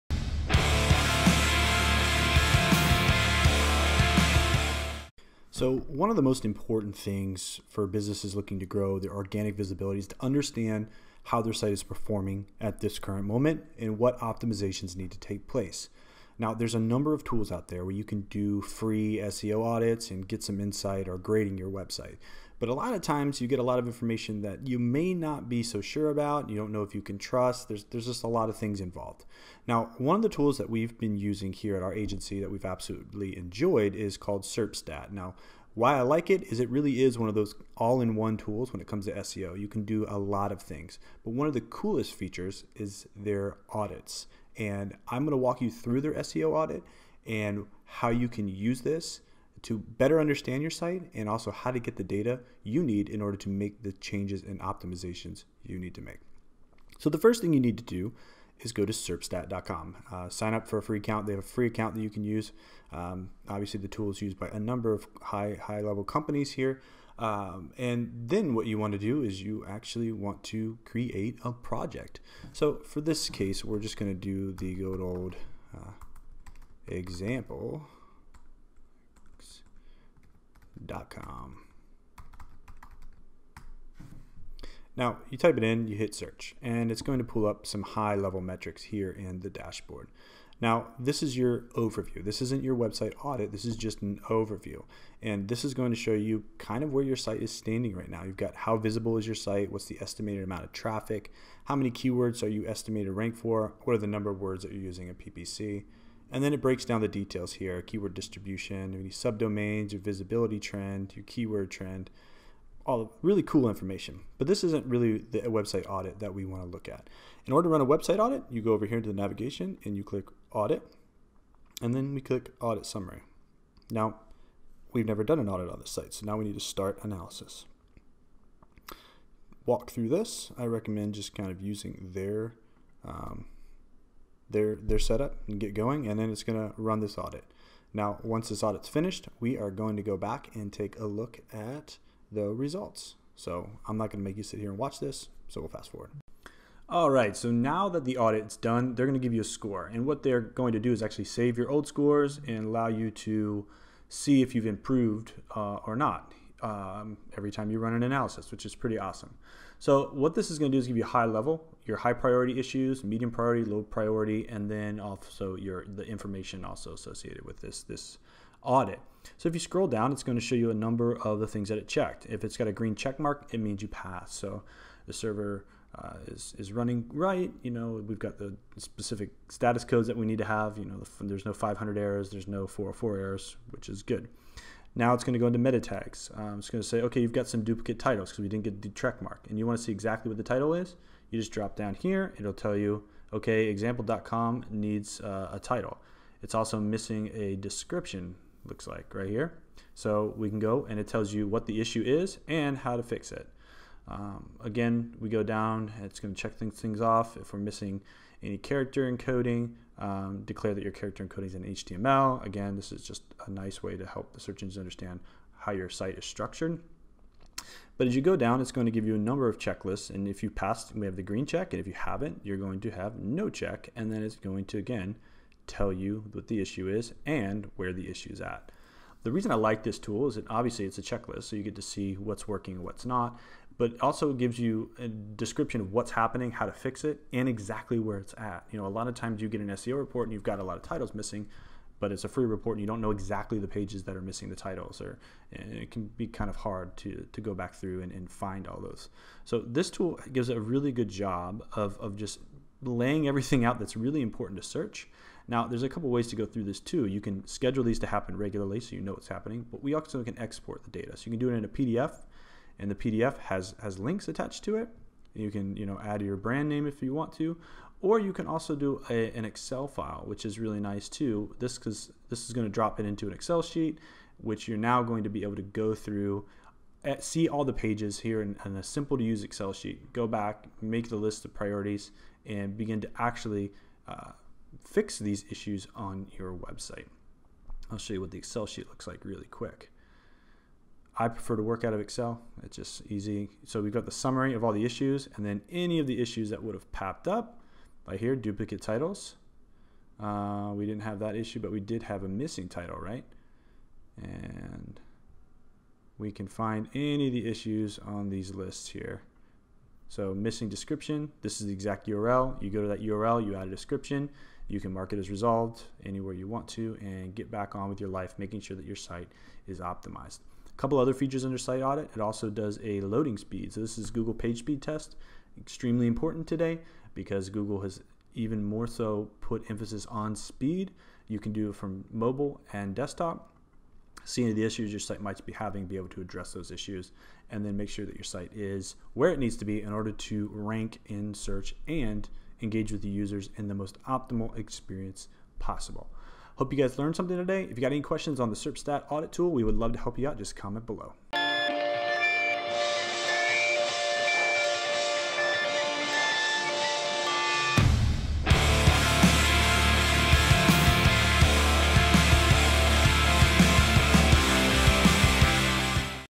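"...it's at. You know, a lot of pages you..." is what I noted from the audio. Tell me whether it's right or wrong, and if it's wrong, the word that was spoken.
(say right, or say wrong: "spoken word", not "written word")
wrong: "times", not "pages".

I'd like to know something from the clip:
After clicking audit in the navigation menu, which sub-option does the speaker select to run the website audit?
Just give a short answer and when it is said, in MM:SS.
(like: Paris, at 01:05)
audit summary, at 02:02.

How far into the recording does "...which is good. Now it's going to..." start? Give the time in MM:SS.
03:03.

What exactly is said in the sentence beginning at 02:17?
Now, once this audit's finished, we are going to go back and take a look at the results.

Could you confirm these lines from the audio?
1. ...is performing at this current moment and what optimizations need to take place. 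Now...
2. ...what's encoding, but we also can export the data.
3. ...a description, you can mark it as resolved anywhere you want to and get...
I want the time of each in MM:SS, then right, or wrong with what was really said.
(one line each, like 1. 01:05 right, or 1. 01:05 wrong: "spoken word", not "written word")
1. 00:11 right
2. 04:19 wrong: "happening", not "encoding"
3. 05:13 right.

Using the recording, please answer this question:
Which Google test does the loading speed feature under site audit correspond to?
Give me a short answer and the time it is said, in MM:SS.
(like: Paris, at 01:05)
Google Page Speed Test, at 05:24.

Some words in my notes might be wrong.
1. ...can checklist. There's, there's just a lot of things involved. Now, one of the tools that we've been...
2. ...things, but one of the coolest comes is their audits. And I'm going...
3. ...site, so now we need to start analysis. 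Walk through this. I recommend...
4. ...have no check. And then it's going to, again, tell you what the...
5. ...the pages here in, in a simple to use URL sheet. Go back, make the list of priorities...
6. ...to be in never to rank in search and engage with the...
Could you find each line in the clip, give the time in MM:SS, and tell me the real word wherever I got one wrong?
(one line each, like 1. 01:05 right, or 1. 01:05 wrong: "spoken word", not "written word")
1. 00:27 wrong: "trust", not "checklist"
2. 00:40 wrong: "features", not "comes"
3. 02:05 right
4. 03:42 right
5. 04:37 wrong: "Excel", not "URL"
6. 05:39 wrong: "order", not "never".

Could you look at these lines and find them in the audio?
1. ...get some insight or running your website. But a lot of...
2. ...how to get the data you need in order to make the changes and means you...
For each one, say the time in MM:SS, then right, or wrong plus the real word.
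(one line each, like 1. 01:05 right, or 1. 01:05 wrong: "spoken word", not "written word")
1. 00:20 wrong: "grading", not "running"
2. 00:51 wrong: "optimizations", not "means".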